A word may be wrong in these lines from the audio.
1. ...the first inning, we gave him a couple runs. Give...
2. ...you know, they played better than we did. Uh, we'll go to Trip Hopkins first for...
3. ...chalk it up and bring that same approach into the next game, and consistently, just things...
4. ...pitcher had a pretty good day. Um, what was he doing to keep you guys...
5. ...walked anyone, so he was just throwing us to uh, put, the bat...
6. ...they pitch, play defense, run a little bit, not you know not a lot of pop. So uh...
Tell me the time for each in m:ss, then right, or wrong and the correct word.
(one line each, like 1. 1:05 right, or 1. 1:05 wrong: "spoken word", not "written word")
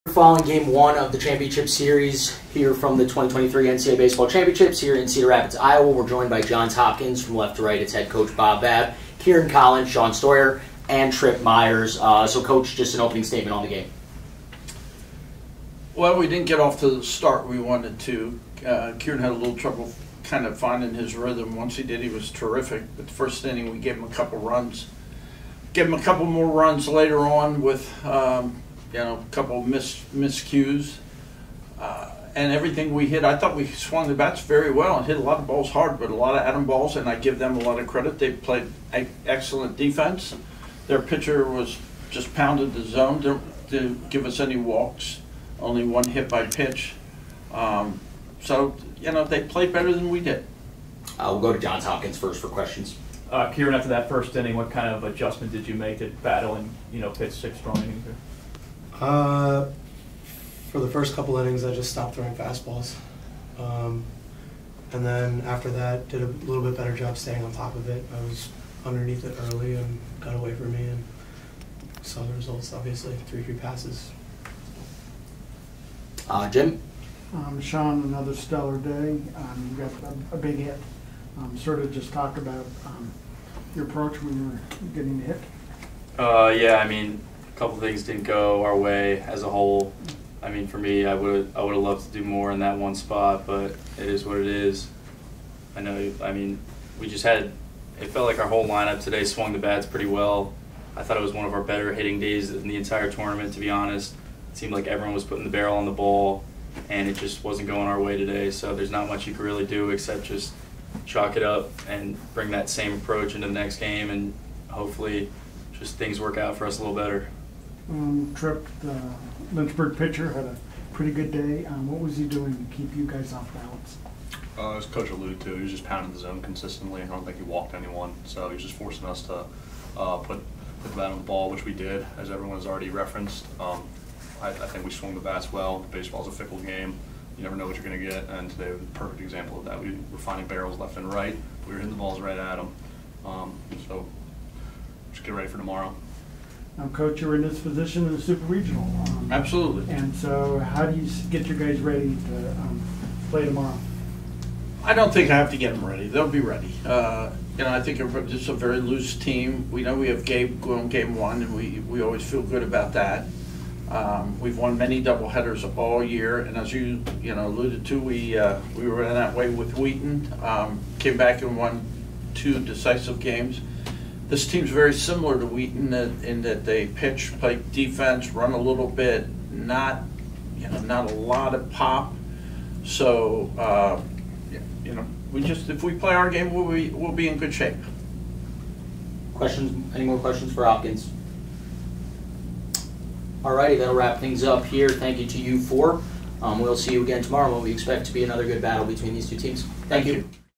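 1. 0:23 right
2. 0:49 wrong: "Johns", not "Trip"
3. 1:51 wrong: "hopefully", not "consistently"
4. 1:59 right
5. 2:07 wrong: "forcing", not "throwing"
6. 2:56 right.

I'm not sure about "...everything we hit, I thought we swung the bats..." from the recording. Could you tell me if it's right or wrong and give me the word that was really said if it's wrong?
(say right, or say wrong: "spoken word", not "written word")
right.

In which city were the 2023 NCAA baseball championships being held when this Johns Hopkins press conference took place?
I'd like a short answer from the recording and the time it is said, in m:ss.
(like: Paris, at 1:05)
Cedar Rapids, Iowa, at 0:05.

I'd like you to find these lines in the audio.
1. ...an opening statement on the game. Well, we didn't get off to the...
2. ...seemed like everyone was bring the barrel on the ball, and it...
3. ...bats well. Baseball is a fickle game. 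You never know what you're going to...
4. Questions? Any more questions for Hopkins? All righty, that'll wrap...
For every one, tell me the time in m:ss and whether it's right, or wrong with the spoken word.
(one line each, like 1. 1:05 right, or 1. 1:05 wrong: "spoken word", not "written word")
1. 0:12 right
2. 1:44 wrong: "putting", not "bring"
3. 2:15 right
4. 3:09 right.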